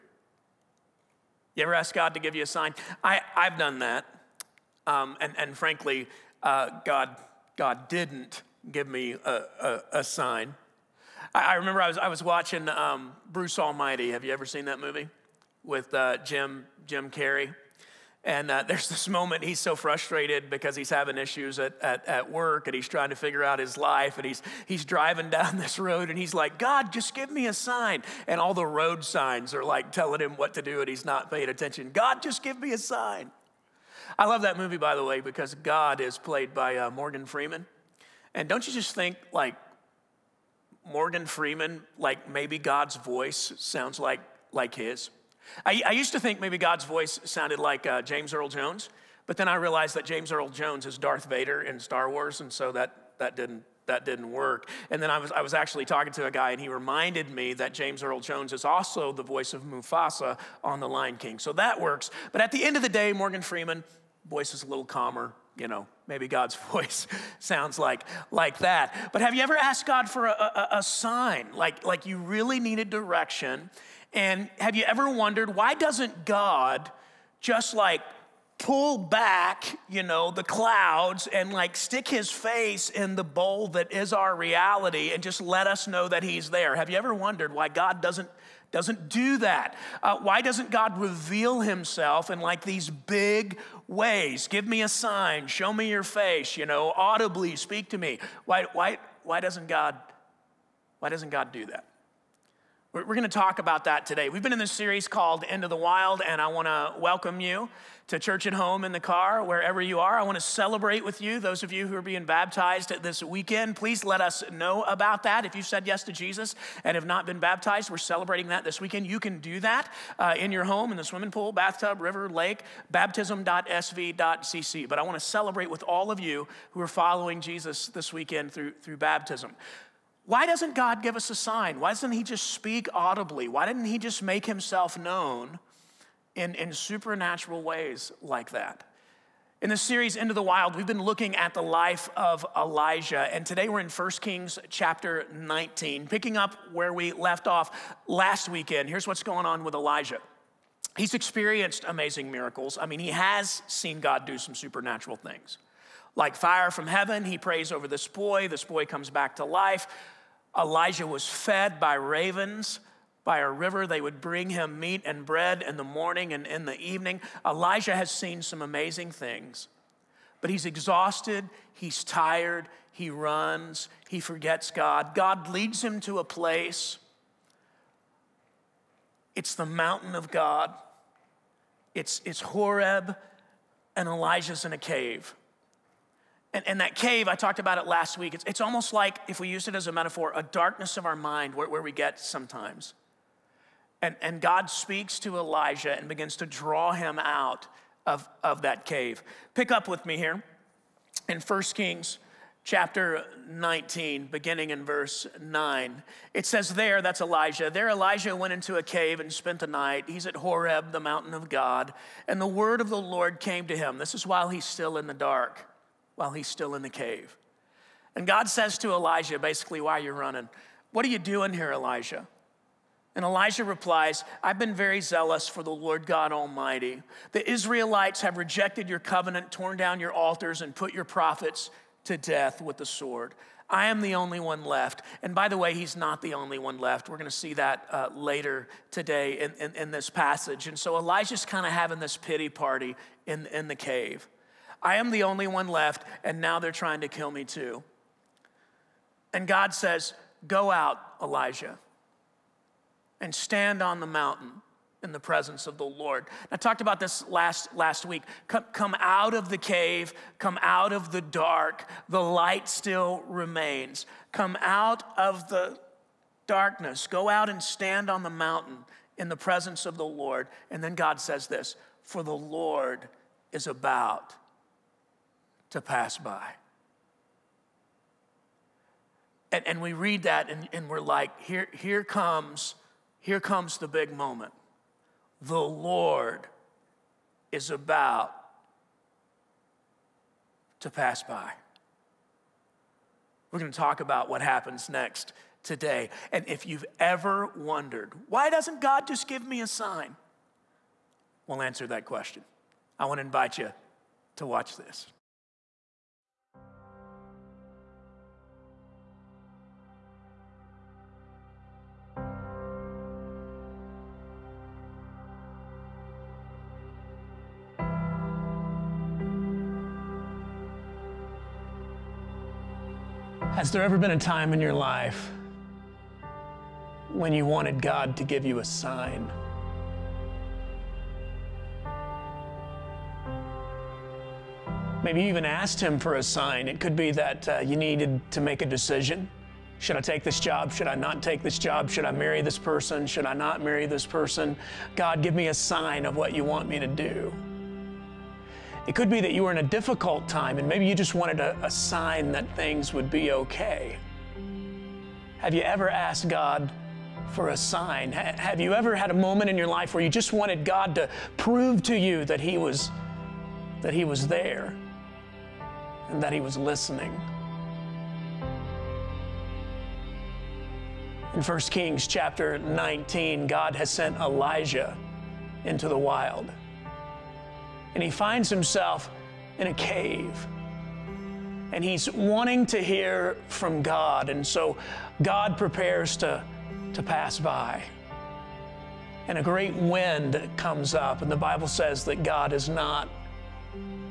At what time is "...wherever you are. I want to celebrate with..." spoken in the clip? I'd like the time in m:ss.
1:49.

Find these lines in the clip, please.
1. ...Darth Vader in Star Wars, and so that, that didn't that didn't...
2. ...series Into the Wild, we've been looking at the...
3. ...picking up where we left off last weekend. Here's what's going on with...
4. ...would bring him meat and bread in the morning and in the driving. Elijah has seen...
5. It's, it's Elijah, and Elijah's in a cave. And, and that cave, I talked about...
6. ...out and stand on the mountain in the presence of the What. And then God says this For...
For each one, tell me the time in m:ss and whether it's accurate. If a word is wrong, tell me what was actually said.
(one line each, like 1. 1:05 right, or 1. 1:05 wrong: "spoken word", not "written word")
1. 0:50 right
2. 2:19 right
3. 2:26 right
4. 2:44 wrong: "evening", not "driving"
5. 3:01 wrong: "Horeb", not "Elijah"
6. 4:27 wrong: "Lord", not "What".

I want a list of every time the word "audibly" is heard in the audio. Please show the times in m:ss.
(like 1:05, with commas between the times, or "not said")
1:36, 2:12.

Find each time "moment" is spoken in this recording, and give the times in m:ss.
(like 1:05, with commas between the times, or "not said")
0:19, 4:44, 5:59.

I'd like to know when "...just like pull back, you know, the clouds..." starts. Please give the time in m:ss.
1:17.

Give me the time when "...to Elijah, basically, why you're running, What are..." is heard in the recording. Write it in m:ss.
3:38.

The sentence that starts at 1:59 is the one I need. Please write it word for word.
You can do that uh, in your home, in the swimming pool, bathtub, river, lake, baptism.sv.cc.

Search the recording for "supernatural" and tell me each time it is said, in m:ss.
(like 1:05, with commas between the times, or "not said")
2:16, 2:34.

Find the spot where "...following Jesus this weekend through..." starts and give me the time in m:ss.
2:06.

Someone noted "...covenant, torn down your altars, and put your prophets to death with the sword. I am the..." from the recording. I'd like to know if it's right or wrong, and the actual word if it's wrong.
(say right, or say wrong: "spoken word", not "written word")
right.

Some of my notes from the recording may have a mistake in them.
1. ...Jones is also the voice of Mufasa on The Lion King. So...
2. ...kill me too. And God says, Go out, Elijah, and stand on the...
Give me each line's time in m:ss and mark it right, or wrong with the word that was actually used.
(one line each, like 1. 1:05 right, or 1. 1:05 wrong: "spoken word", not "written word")
1. 0:58 right
2. 4:07 right.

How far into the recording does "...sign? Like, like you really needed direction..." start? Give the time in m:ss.
1:10.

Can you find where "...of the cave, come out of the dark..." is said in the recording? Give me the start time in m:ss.
4:19.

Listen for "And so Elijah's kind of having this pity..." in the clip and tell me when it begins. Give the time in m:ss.
4:00.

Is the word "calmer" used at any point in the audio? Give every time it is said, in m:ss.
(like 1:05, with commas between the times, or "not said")
1:04.